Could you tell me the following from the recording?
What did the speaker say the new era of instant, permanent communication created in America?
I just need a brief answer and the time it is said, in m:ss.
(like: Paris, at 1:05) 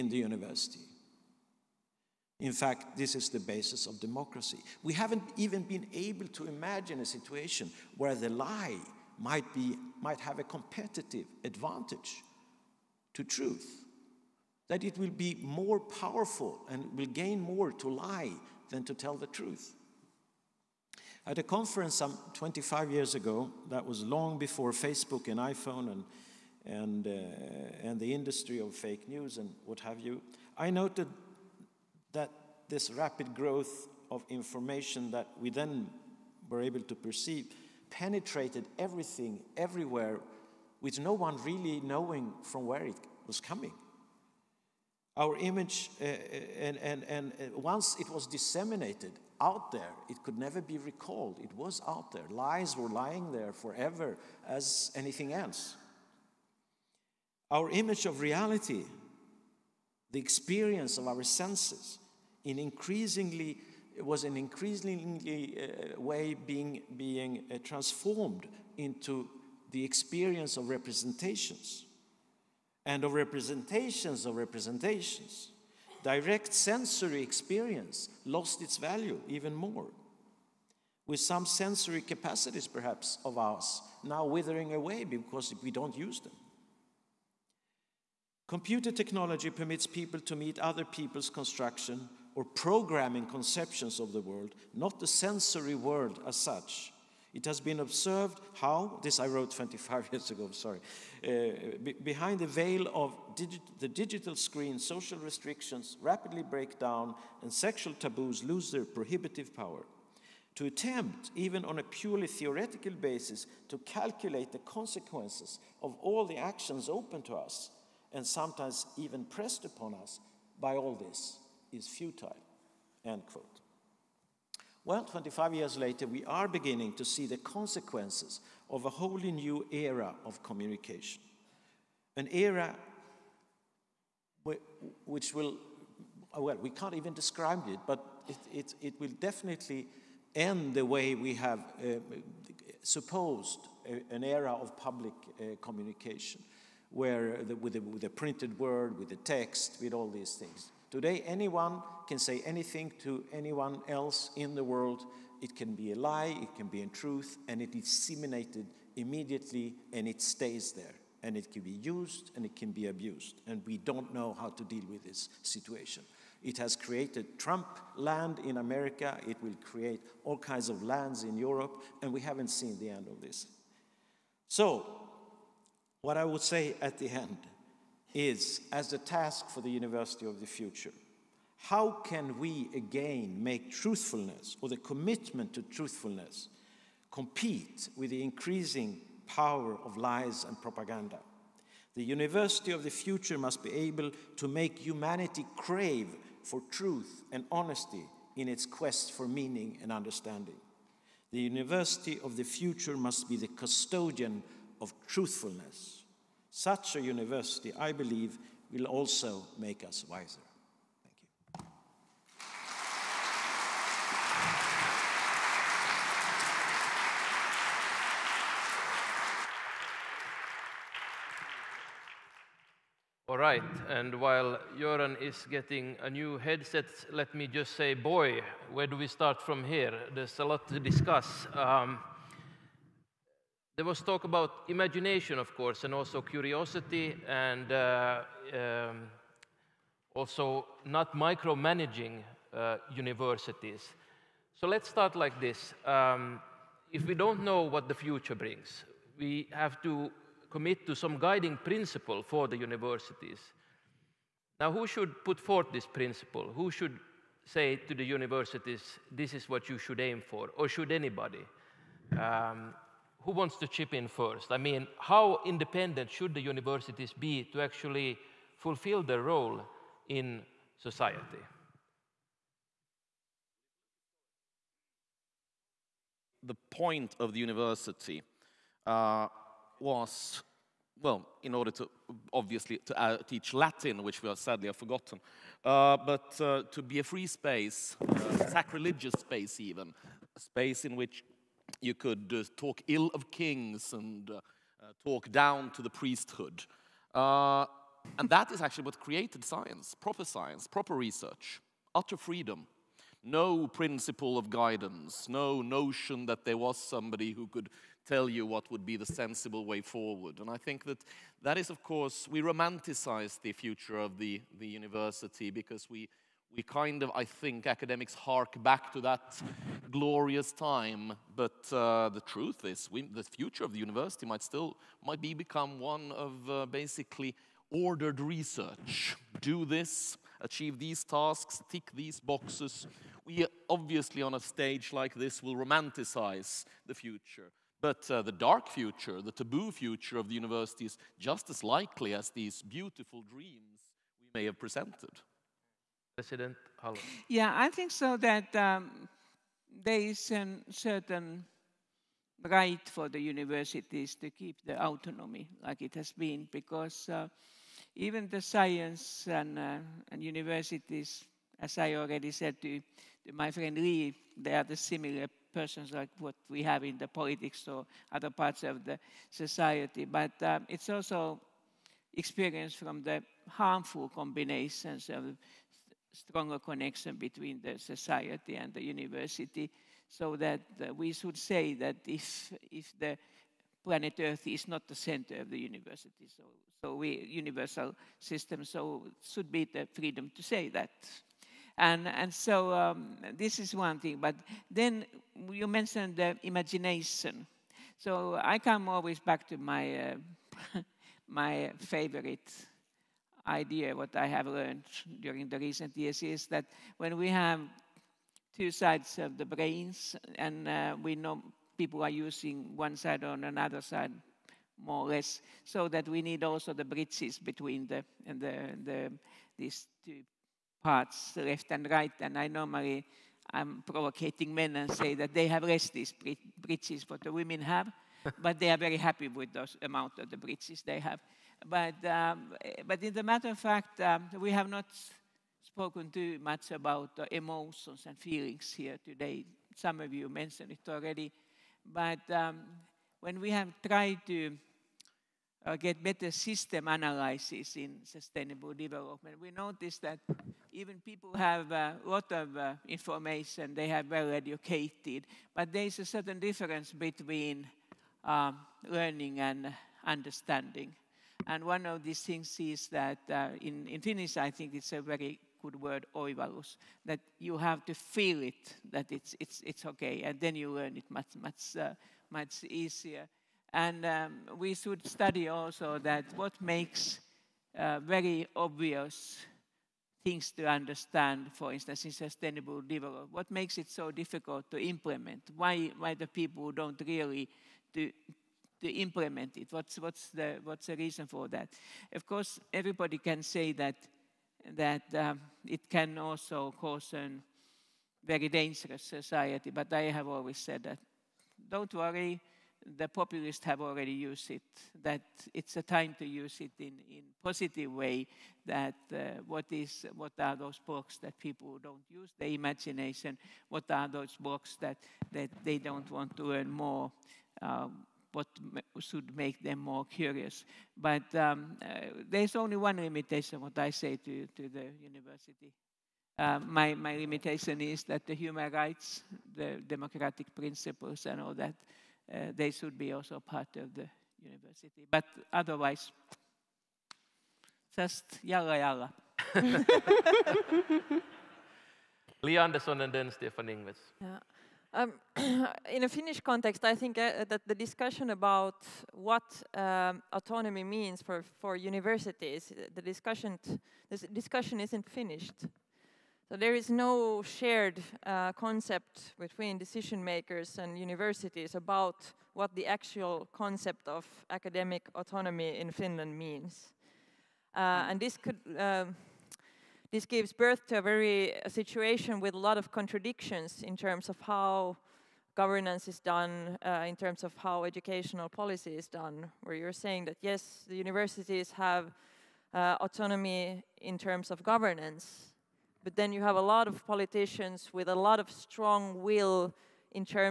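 Trump land, at 2:47.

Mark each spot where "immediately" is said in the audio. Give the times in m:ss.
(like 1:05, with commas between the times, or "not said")
2:38.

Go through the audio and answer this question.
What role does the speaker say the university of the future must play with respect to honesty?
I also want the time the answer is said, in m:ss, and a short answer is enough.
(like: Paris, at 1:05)
custodian of truthfulness, at 3:23.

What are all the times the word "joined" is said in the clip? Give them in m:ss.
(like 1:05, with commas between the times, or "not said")
not said.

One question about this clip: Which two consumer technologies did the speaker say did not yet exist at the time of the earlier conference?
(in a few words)
Facebook and iPhone.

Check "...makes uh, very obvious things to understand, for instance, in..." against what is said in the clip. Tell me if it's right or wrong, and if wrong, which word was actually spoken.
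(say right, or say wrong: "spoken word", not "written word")
right.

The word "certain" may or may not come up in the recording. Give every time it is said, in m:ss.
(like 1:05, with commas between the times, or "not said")
5:50, 7:36.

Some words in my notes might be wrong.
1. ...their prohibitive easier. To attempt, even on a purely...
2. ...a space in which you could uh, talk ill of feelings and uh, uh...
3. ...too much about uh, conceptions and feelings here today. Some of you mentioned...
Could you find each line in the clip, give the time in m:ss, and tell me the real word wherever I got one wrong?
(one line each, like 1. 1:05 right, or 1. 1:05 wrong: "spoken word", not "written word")
1. 1:48 wrong: "power", not "easier"
2. 4:50 wrong: "kings", not "feelings"
3. 7:16 wrong: "emotions", not "conceptions".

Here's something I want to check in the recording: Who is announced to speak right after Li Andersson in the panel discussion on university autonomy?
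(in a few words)
Stefan Ingves.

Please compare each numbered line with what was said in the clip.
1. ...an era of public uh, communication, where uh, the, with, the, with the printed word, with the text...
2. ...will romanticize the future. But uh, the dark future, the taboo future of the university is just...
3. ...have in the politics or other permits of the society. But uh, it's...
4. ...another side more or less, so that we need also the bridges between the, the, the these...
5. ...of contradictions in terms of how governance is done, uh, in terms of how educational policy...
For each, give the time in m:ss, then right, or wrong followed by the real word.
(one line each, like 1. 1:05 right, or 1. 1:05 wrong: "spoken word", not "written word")
1. 2:24 right
2. 5:35 right
3. 6:06 wrong: "parts", not "permits"
4. 6:53 right
5. 9:32 right.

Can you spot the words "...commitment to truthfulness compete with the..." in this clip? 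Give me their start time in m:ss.
3:04.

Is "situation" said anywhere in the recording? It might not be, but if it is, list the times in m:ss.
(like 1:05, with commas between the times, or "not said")
0:07, 2:45, 9:31.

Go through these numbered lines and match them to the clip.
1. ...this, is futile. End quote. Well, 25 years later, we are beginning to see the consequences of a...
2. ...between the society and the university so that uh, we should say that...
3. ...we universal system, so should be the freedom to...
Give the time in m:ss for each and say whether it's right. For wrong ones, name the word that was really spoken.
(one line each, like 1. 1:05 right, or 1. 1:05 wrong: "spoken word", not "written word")
1. 2:00 right
2. 6:17 right
3. 6:26 right.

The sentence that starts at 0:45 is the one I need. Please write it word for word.
Our image, uh, uh and, and, and uh, once it was disseminated, out there.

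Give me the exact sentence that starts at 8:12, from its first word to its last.
Of course, everybody can say that, that um, it can also cause a very dangerous society, but I have always said that.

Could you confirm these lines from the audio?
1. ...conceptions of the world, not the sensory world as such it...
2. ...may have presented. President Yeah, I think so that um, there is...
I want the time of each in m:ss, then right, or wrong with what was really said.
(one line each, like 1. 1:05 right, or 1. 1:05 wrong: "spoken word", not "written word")
1. 1:33 right
2. 5:44 right.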